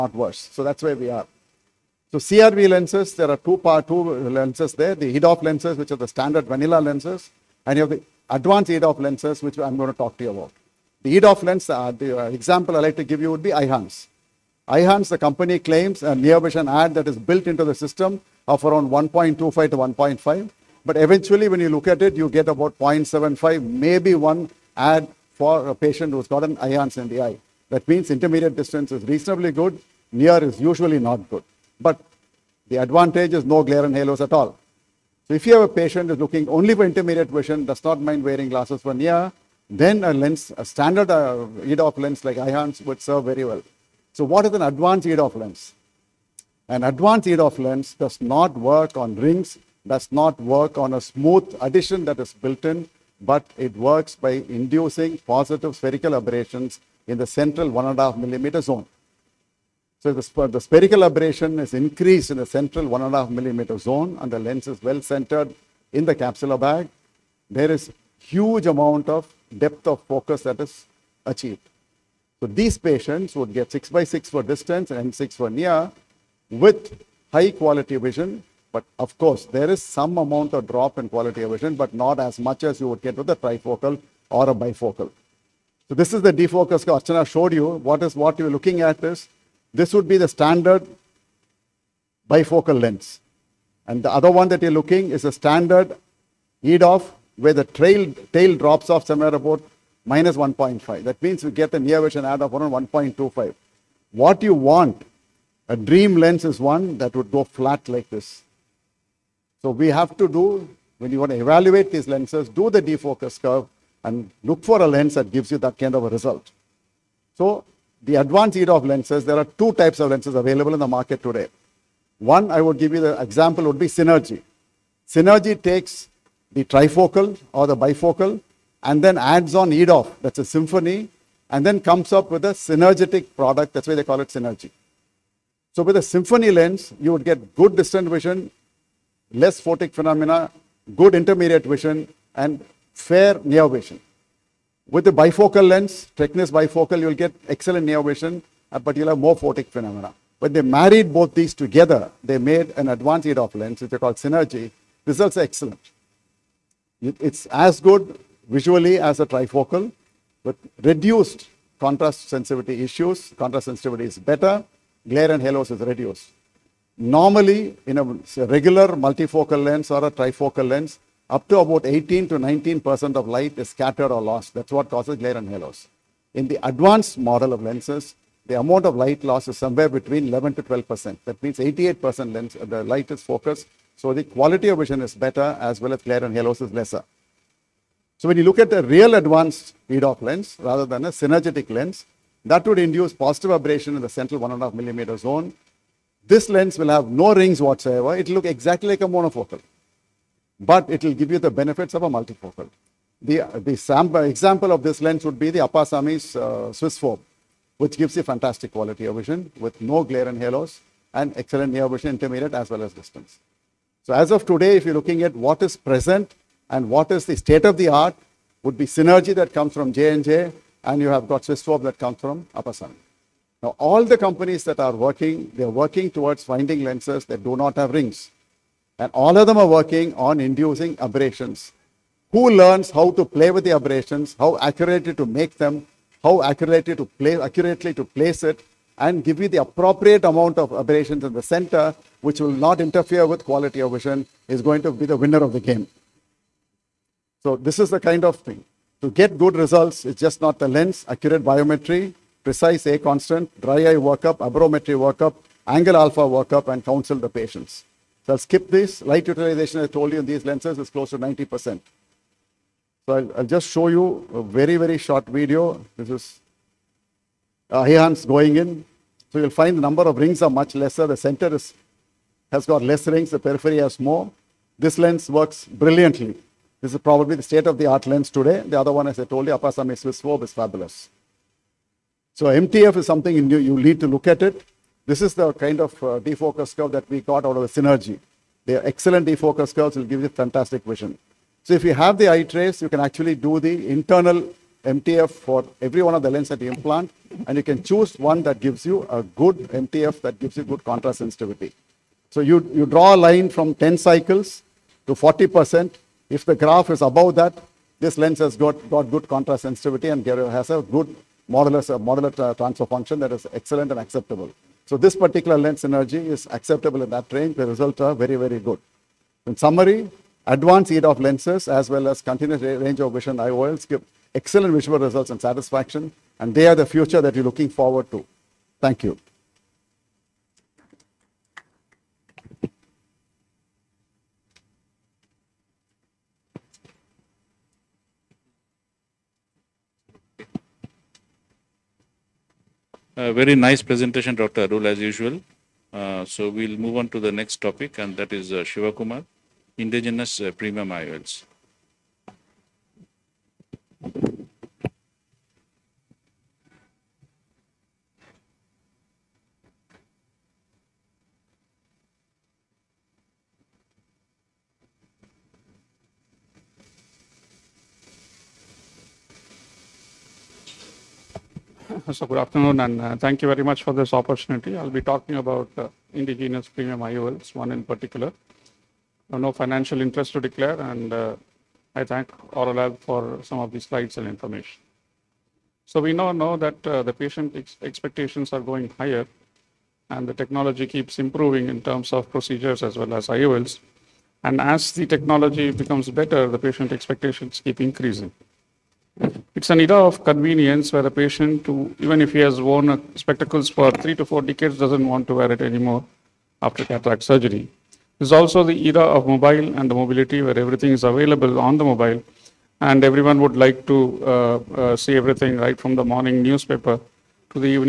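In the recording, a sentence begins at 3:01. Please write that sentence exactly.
That means 88% lens, the light is focused.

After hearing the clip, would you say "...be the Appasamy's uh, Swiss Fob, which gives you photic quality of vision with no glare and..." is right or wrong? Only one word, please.
wrong.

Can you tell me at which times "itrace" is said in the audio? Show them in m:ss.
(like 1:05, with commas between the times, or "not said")
4:52.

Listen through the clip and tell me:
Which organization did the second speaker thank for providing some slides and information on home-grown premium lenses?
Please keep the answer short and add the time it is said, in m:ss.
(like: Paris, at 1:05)
Aurolab, at 6:22.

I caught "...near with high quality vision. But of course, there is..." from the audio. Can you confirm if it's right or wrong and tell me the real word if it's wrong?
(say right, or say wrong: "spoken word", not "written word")
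right.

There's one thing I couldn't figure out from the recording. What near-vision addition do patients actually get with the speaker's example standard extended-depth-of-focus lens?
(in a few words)
0.75.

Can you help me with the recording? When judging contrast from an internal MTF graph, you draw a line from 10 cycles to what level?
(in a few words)
40%.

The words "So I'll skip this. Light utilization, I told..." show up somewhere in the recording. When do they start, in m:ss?
4:18.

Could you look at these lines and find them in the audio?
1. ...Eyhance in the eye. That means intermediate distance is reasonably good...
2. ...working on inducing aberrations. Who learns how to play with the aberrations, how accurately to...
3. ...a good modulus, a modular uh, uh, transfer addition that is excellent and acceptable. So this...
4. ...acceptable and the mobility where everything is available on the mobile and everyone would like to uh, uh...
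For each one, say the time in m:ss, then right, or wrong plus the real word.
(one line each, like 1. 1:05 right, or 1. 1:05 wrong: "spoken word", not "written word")
1. 0:26 right
2. 3:49 right
3. 5:10 wrong: "function", not "addition"
4. 6:49 wrong: "mobile", not "acceptable".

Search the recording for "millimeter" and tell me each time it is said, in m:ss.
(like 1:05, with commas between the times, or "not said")
0:58, 1:03, 3:14.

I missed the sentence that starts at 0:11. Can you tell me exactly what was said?
The EDOF lens, uh, the uh, example I like to give you would be Eyhance.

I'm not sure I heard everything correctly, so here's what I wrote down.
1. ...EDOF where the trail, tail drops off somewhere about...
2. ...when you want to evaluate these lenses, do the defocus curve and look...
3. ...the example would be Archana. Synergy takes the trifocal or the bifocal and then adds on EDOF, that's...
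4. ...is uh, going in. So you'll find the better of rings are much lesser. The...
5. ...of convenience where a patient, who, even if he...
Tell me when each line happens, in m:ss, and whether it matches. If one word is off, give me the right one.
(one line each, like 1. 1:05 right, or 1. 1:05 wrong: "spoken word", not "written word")
1. 1:36 right
2. 1:50 right
3. 2:03 wrong: "Synergy", not "Archana"
4. 4:26 wrong: "number", not "better"
5. 6:40 right.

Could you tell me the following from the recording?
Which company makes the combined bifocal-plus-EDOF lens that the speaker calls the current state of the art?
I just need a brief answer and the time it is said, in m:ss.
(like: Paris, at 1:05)
J&J, at 3:39.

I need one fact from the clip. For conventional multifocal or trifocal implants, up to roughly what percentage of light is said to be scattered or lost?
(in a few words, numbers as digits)
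18 to 19%.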